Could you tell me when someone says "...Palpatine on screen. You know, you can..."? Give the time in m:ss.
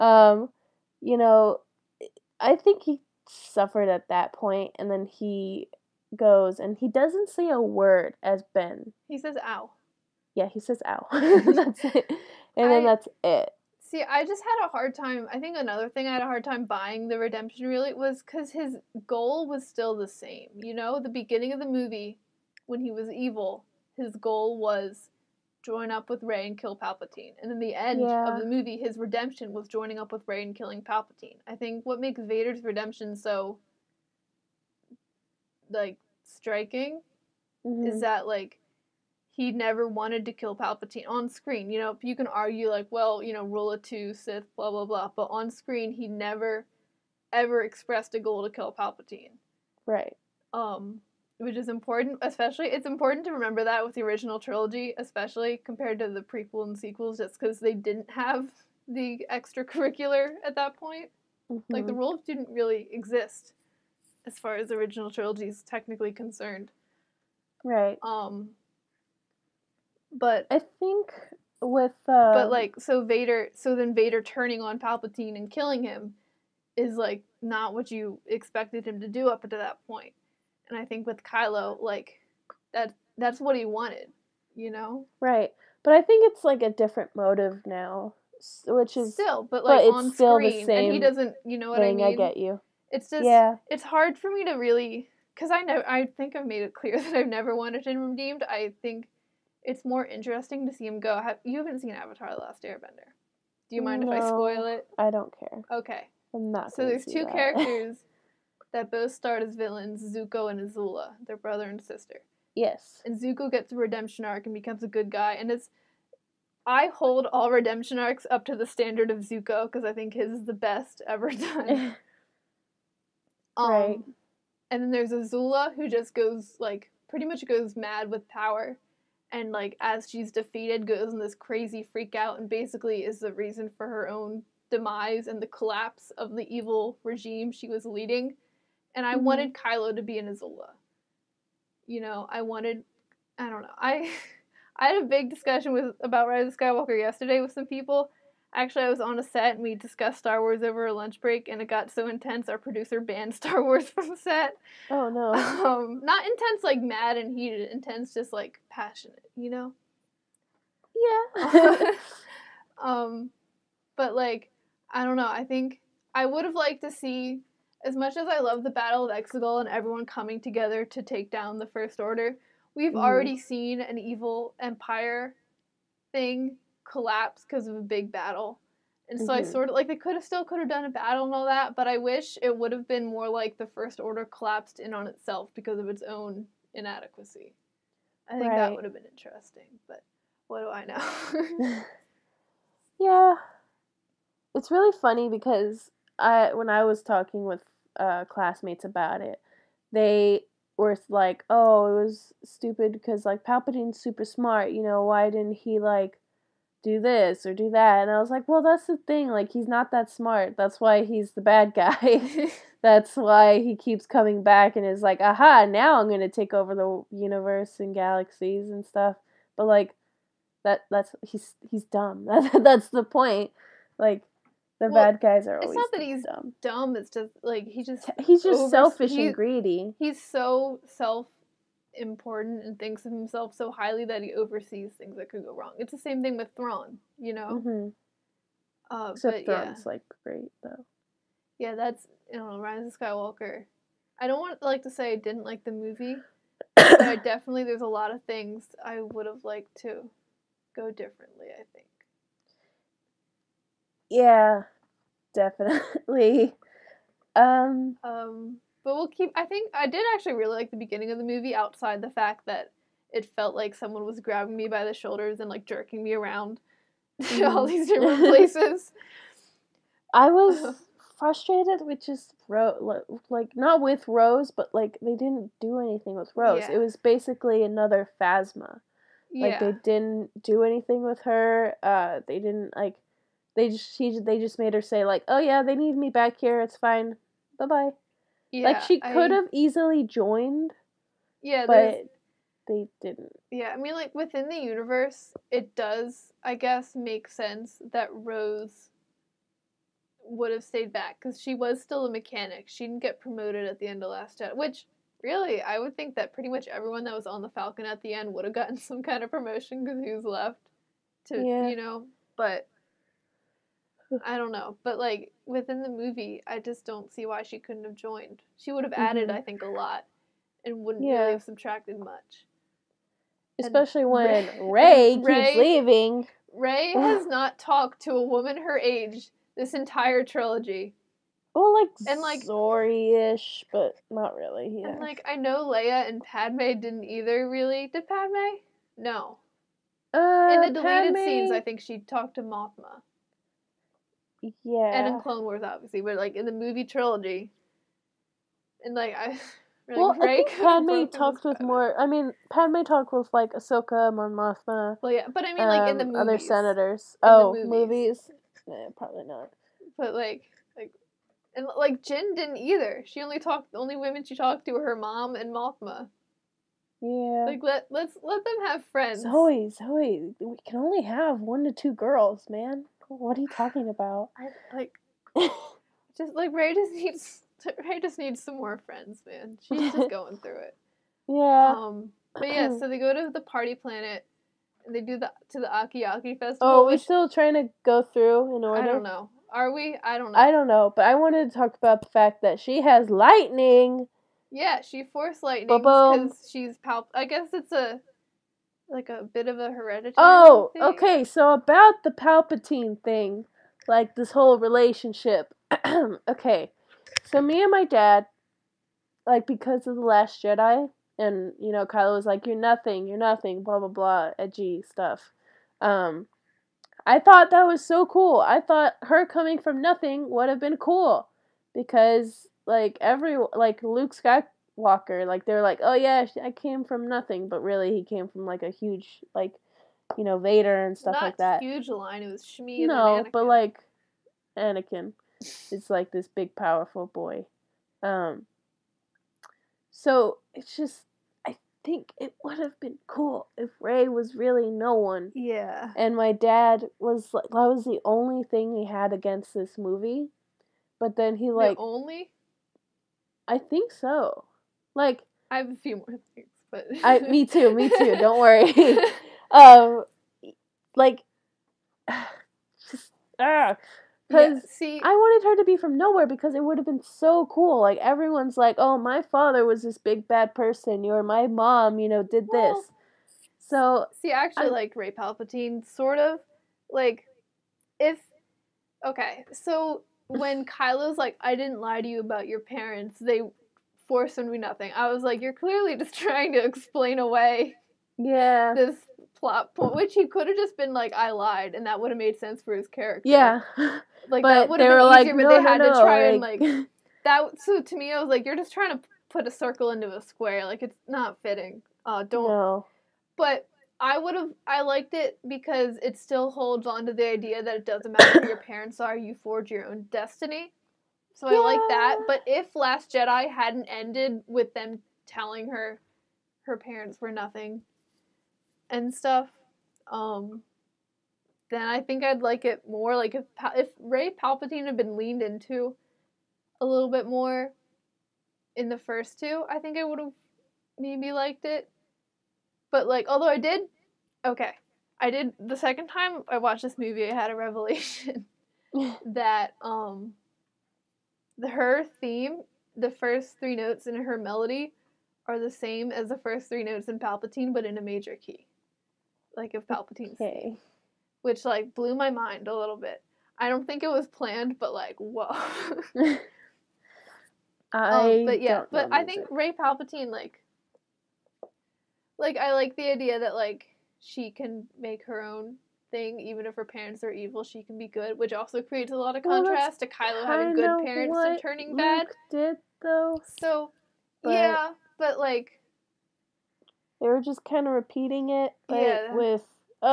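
0:40.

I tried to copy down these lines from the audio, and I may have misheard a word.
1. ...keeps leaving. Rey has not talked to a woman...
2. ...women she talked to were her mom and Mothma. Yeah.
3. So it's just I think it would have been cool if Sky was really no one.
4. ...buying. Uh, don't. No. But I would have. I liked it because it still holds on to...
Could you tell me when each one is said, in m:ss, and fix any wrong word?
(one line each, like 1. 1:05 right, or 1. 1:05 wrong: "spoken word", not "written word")
1. 5:25 right
2. 6:03 right
3. 7:19 wrong: "Rey", not "Sky"
4. 8:21 wrong: "fitting", not "buying".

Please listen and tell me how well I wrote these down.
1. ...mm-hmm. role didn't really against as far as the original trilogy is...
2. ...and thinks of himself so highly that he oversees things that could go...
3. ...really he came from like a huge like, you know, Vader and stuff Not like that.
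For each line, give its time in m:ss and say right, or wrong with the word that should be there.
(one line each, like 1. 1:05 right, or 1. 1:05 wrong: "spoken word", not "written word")
1. 1:01 wrong: "exist", not "against"
2. 3:52 right
3. 7:07 right.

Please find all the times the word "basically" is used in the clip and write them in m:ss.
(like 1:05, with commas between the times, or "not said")
2:12, 4:36.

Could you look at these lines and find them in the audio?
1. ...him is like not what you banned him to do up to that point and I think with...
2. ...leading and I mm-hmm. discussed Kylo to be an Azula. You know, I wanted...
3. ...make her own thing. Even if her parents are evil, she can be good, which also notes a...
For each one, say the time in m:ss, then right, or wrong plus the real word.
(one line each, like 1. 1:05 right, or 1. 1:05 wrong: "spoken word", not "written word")
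1. 1:15 wrong: "expected", not "banned"
2. 2:17 wrong: "wanted", not "discussed"
3. 9:24 wrong: "creates", not "notes".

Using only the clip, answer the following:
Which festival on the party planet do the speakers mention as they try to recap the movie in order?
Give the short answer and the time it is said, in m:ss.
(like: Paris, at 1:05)
Aki-Aki festival, at 6:25.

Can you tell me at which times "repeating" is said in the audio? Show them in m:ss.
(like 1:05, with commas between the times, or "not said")
9:37.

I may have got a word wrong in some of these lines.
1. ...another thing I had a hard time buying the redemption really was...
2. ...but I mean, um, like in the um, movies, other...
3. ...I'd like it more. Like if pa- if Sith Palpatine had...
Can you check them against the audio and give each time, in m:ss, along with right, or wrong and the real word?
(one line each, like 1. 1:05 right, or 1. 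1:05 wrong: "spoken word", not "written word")
1. 0:15 right
2. 5:55 right
3. 8:42 wrong: "Rey", not "Sith".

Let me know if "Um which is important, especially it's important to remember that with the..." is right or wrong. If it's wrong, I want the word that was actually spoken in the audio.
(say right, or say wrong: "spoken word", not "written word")
right.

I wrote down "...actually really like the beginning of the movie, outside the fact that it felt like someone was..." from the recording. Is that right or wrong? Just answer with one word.
right.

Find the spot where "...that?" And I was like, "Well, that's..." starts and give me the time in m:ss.
3:27.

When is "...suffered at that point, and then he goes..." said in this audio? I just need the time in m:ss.
0:03.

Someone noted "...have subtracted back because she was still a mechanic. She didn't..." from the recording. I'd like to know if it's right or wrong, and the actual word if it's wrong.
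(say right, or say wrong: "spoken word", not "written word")
wrong: "stayed", not "subtracted".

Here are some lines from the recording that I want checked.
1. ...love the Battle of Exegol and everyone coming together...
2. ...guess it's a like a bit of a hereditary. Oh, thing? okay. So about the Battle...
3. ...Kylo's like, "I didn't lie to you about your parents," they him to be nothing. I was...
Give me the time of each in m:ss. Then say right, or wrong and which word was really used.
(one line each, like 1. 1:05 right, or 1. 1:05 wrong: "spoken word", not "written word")
1. 2:48 right
2. 6:37 wrong: "Palpatine", not "Battle"
3. 8:00 right.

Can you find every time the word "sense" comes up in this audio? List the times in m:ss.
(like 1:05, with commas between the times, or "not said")
4:57, 8:12.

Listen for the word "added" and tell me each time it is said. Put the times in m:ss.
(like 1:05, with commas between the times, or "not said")
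5:18.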